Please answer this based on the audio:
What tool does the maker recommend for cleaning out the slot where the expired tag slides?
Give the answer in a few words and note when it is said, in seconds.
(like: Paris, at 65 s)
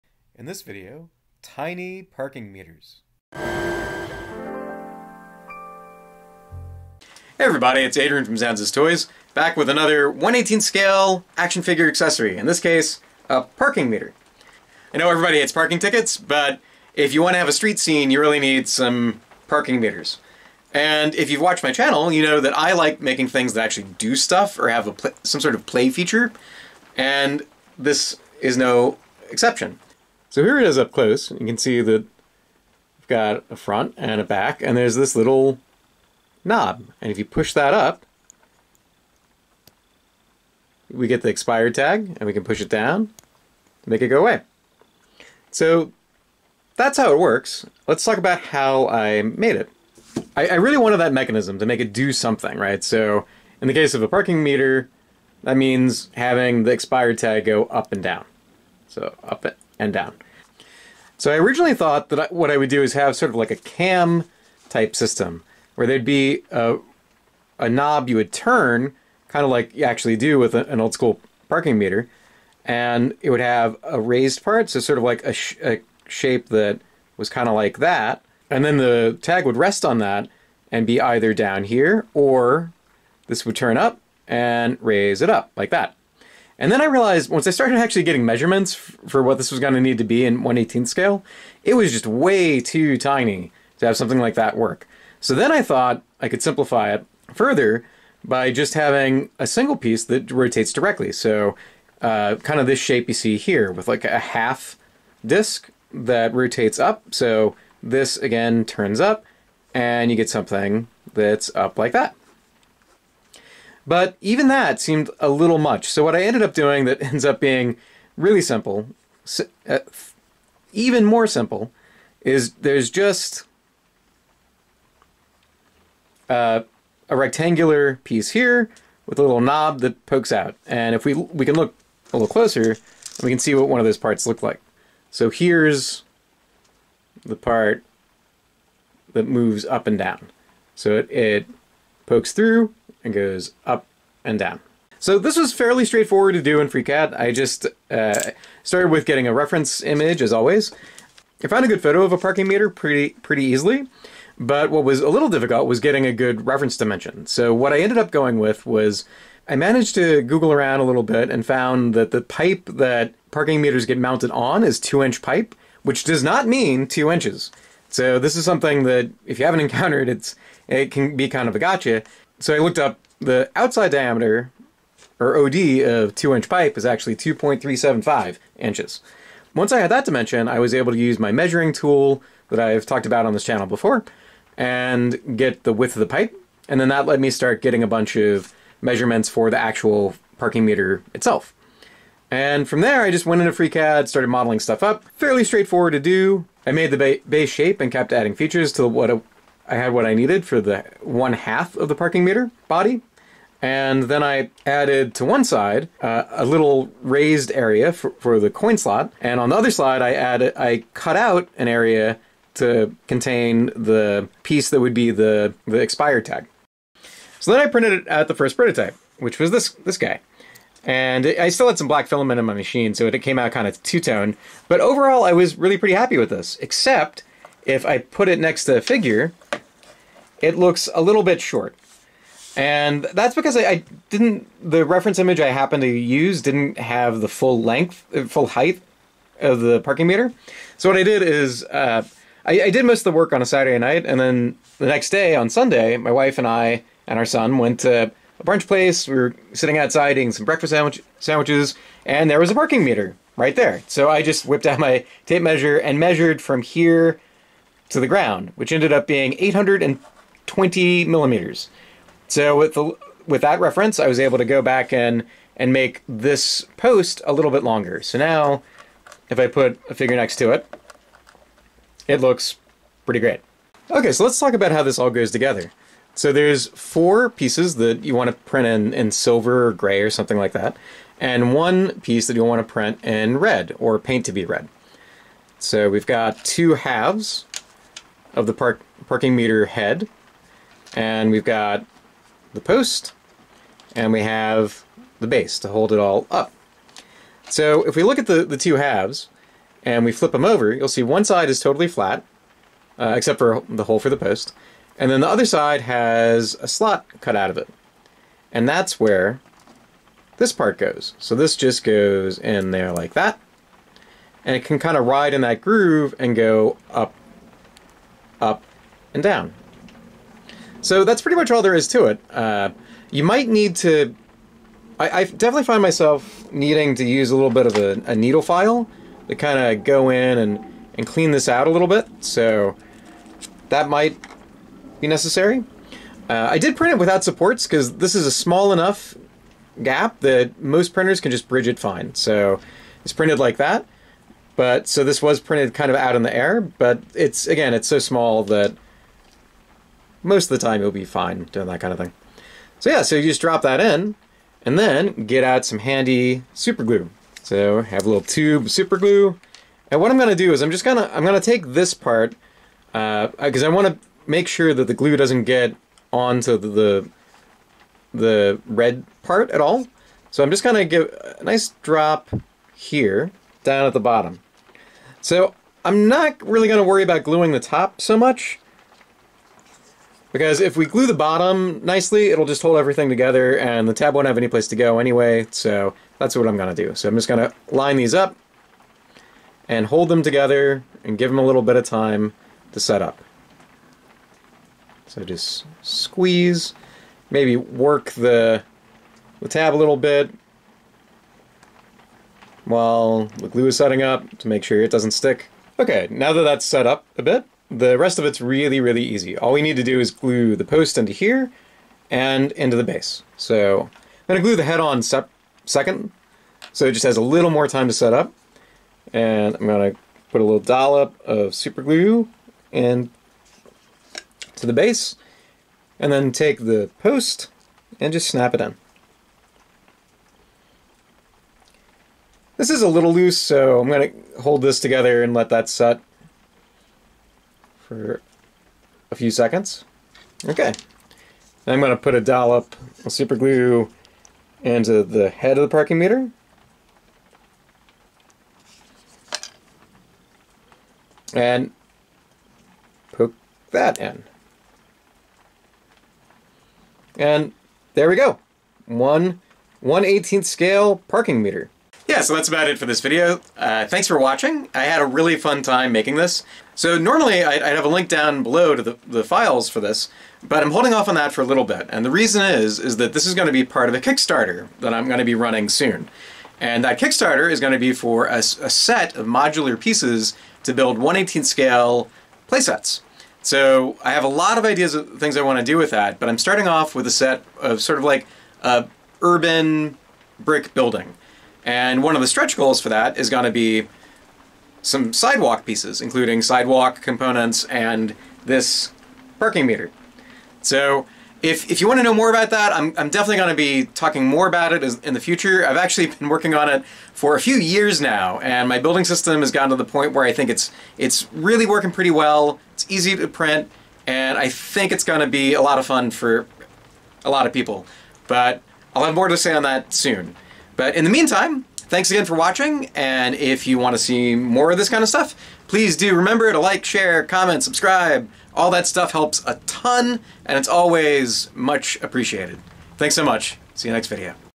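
needle file, at 328 s.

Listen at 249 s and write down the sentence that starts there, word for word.
We were sitting outside eating some breakfast sandwich, sandwiches, and there was a parking meter right there.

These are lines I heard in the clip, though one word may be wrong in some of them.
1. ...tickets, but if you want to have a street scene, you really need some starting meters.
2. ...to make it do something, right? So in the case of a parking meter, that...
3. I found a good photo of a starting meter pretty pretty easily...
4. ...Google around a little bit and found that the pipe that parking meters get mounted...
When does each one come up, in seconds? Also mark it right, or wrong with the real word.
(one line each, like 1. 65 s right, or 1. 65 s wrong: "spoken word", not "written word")
1. 15 s wrong: "parking", not "starting"
2. 51 s right
3. 151 s wrong: "parking", not "starting"
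4. 160 s right.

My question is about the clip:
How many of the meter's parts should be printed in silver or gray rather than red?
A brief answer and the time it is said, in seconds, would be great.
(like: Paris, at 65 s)
4, at 276 s.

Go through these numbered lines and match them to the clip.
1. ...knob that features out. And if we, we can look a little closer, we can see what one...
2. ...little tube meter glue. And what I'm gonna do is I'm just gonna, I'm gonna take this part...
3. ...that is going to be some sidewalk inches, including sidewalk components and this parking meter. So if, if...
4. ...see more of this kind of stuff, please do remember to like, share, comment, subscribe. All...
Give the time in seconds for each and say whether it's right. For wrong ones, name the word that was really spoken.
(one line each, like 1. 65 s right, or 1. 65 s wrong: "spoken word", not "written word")
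1. 129 s wrong: "pokes", not "features"
2. 358 s wrong: "super", not "meter"
3. 492 s wrong: "pieces", not "inches"
4. 524 s right.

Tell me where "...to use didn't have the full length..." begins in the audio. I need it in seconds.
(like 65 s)
235 s.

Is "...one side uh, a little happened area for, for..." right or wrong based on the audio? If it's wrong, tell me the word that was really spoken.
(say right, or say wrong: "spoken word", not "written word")
wrong: "raised", not "happened".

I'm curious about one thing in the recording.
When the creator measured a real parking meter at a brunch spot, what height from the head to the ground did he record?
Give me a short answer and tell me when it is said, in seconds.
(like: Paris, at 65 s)
820 millimeters, at 259 s.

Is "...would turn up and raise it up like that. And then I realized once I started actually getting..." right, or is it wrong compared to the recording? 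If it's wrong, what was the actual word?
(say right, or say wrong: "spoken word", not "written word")
right.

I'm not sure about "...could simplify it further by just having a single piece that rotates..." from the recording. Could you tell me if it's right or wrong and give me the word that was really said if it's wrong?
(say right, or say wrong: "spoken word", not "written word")
right.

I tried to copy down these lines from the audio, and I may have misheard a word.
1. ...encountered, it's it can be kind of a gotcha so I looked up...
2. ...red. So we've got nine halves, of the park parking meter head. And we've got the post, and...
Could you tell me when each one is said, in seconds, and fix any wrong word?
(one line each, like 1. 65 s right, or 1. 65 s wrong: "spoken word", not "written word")
1. 169 s right
2. 284 s wrong: "two", not "nine".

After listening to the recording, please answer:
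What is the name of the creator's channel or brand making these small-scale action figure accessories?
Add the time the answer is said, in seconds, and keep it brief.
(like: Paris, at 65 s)
Zanza's Toys, at 8 s.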